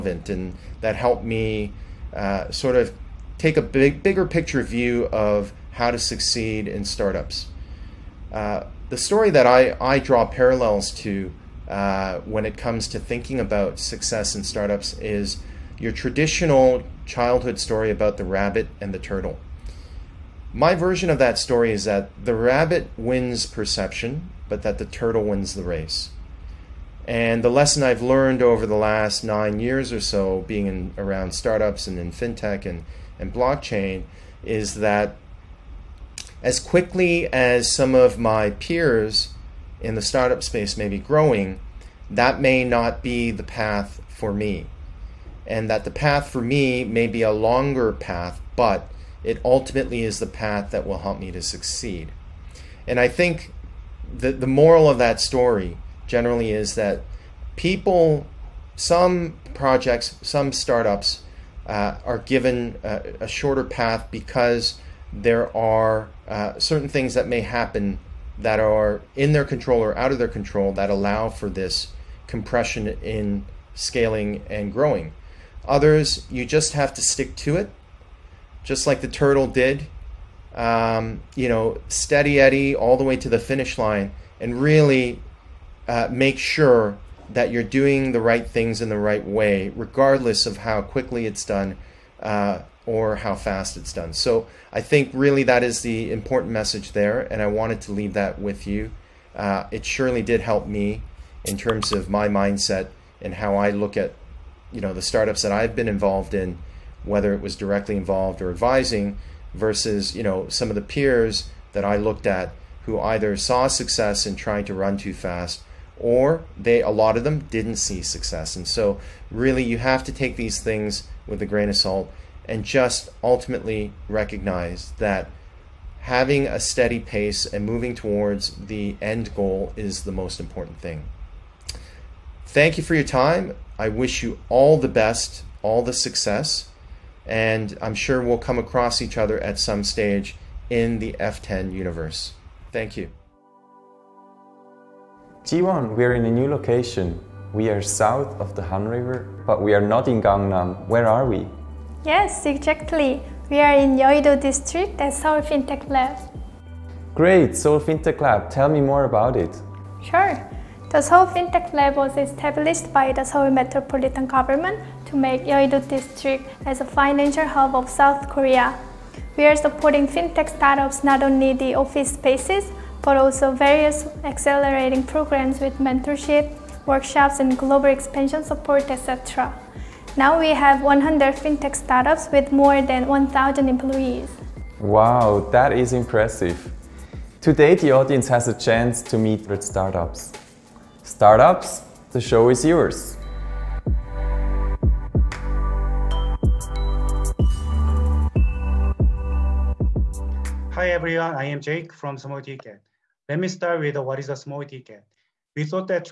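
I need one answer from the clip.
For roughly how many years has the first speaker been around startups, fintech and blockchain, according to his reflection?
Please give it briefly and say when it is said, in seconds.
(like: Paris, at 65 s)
9 years, at 29 s.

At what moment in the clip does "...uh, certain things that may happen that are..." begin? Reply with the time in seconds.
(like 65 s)
66 s.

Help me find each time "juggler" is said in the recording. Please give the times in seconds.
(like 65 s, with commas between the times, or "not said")
not said.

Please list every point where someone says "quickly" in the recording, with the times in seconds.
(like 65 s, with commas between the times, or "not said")
36 s, 90 s.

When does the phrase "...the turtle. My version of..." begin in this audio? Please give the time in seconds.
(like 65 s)
18 s.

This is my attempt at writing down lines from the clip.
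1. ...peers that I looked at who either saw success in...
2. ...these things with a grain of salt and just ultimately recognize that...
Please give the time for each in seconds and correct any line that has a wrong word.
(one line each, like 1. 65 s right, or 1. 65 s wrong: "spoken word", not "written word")
1. 110 s right
2. 120 s right.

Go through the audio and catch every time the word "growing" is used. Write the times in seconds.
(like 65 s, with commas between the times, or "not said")
40 s, 74 s.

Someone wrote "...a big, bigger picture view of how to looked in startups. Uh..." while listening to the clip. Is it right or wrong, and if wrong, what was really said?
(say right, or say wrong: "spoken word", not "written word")
wrong: "succeed", not "looked".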